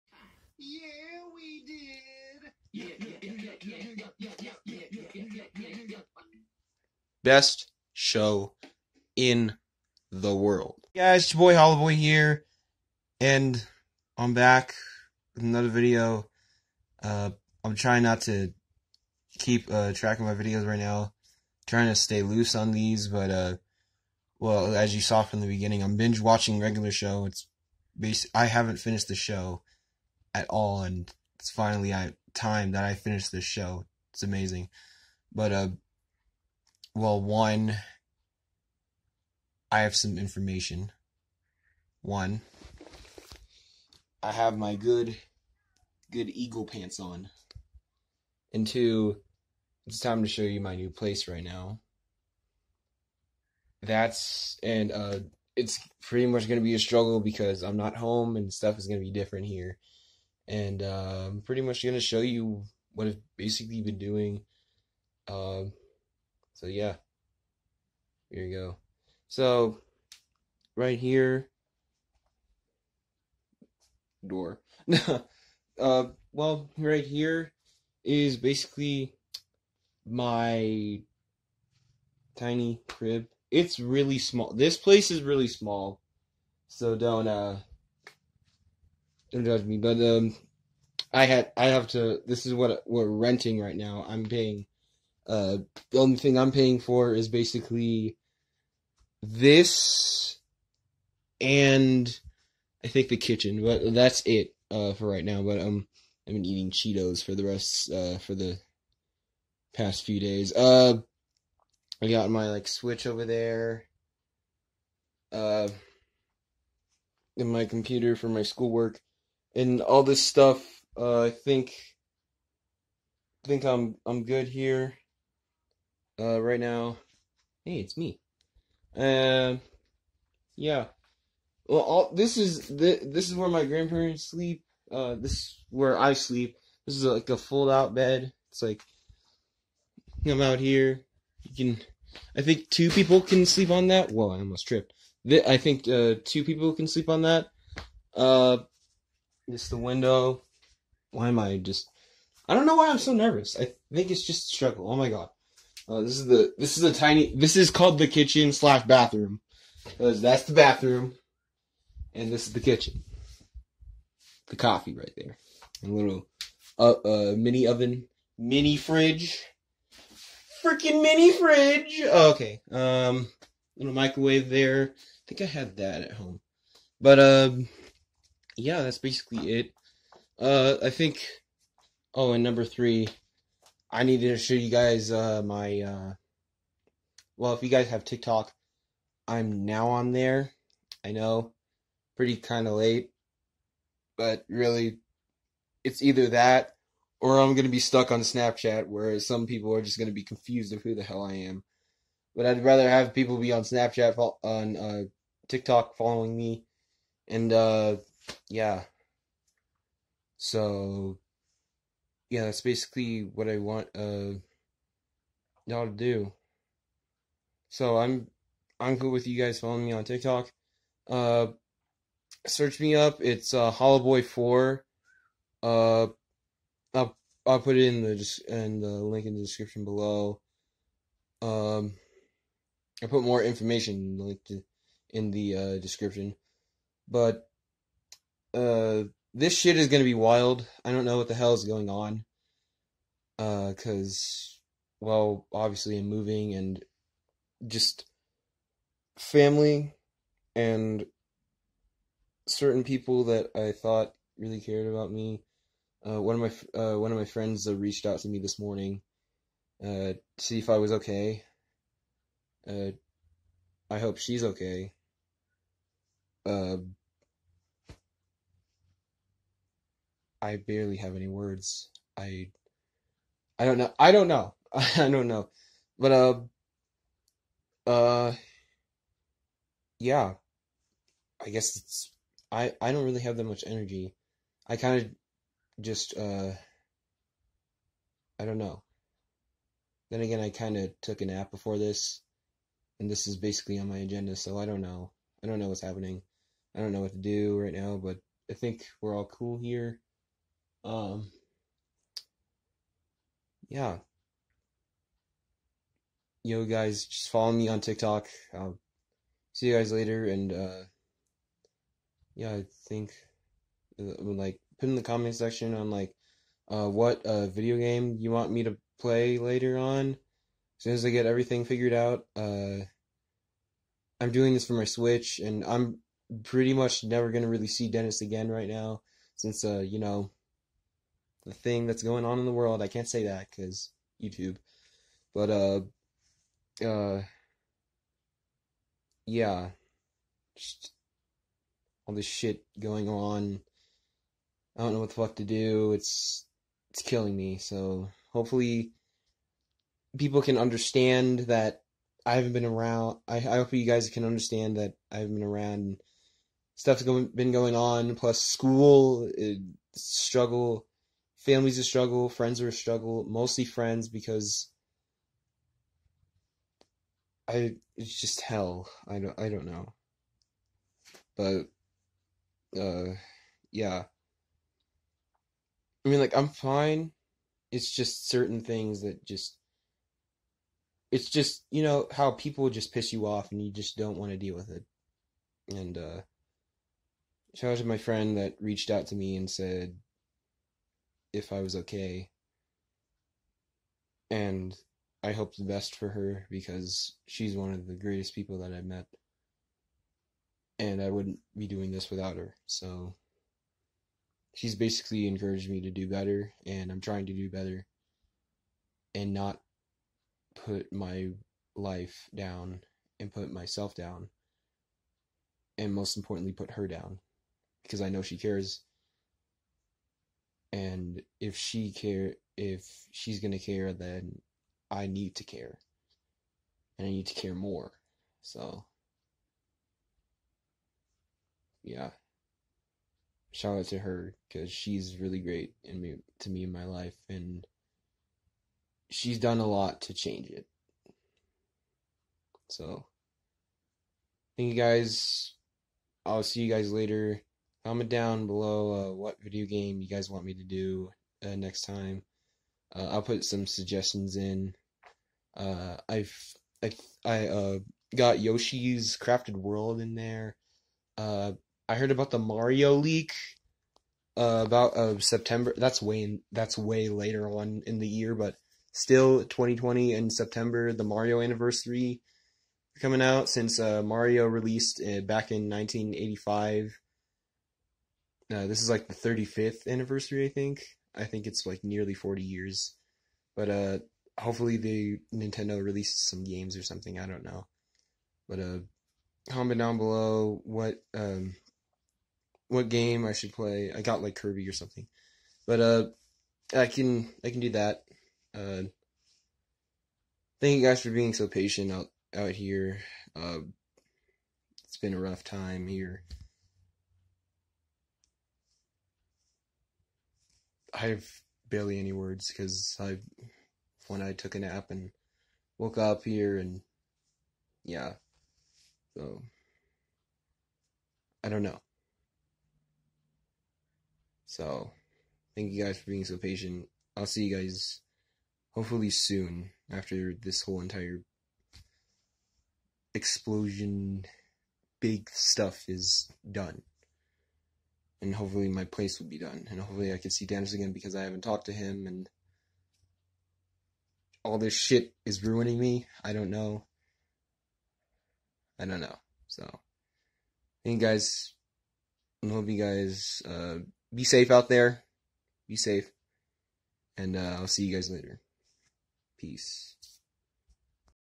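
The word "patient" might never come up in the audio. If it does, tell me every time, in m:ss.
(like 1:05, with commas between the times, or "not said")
8:21, 8:46.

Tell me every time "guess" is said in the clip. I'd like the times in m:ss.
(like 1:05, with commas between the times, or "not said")
4:41.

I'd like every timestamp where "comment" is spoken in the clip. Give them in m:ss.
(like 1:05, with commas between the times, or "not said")
5:15, 7:27, 8:09.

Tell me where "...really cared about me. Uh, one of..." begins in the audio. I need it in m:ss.
4:14.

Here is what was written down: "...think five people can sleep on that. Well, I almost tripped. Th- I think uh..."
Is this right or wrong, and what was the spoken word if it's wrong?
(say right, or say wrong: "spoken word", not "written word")
wrong: "two", not "five".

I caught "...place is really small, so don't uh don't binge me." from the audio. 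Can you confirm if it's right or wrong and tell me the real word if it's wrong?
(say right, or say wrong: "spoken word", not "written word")
wrong: "judge", not "binge".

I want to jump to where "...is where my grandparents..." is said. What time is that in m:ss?
2:13.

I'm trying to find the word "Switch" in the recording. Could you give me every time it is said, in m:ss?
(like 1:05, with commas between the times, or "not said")
1:52, 5:24.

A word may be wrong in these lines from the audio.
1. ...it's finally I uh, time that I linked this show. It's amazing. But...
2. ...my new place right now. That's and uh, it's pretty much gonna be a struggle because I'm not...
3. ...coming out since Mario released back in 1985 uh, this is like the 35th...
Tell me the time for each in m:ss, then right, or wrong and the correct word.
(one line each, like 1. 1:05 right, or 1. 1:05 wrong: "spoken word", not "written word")
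1. 0:31 wrong: "finished", not "linked"
2. 0:50 right
3. 7:52 right.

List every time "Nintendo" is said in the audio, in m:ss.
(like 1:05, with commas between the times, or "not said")
8:05.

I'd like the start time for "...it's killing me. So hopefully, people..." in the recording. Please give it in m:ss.
5:46.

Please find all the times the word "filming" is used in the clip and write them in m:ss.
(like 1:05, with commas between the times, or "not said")
not said.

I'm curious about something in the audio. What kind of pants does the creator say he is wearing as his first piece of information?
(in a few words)
eagle pants.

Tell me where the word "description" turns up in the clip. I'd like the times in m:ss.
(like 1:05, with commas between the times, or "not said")
3:49, 3:55.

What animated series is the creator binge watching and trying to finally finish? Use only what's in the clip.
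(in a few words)
Regular Show.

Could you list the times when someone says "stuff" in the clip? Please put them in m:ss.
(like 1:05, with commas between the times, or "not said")
0:58, 2:00, 5:56, 8:55.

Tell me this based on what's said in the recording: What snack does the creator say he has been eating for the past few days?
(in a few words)
Cheetos.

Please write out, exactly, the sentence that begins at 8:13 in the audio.
I got like Kirby or something.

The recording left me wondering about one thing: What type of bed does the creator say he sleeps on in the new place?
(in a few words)
fold out bed.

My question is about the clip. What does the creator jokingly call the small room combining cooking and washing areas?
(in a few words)
kitchen slash bathroom.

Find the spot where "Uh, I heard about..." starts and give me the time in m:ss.
7:41.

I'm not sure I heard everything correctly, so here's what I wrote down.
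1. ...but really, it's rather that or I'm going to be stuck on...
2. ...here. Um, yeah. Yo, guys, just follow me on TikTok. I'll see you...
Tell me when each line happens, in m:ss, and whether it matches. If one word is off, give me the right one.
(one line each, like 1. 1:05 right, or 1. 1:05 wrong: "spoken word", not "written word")
1. 3:14 wrong: "either", not "rather"
2. 4:59 right.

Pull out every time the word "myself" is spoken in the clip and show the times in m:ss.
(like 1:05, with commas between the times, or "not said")
6:53.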